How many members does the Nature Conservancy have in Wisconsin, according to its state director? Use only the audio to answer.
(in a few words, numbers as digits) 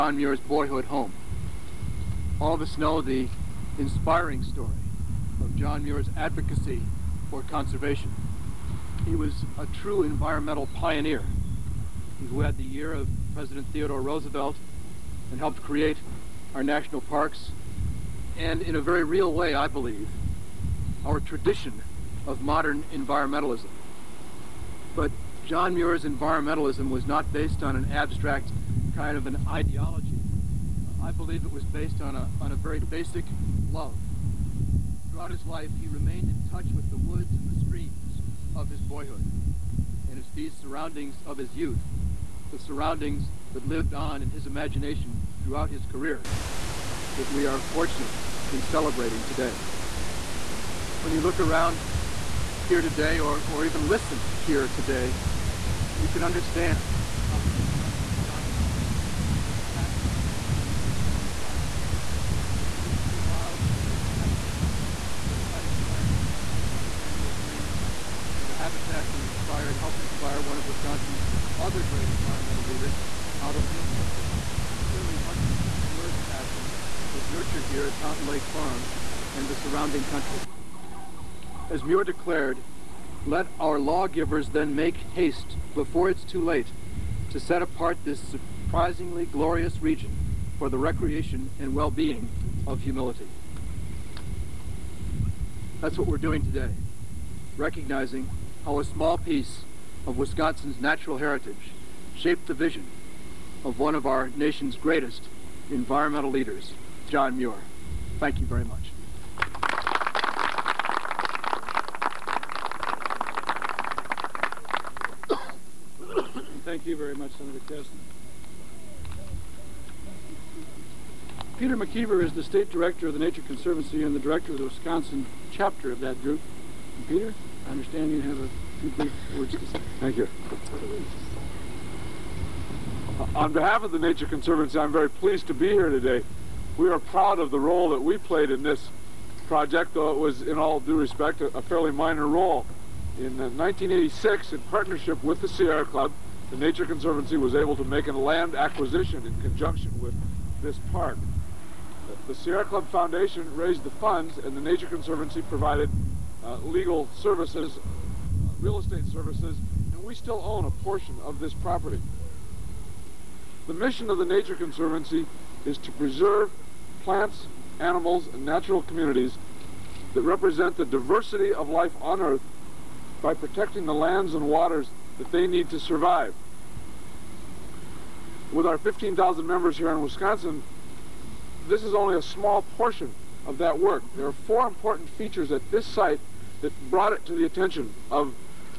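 15,000.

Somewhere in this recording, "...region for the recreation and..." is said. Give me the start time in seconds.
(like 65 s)
89 s.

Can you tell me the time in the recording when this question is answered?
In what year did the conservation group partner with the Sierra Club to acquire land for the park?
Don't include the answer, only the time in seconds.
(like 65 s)
143 s.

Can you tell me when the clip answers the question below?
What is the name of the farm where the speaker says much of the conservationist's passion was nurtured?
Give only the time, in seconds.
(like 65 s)
77 s.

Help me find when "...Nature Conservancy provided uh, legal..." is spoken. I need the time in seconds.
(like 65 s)
154 s.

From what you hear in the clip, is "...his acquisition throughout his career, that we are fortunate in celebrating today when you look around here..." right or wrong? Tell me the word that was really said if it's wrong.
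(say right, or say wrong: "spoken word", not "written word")
wrong: "imagination", not "acquisition".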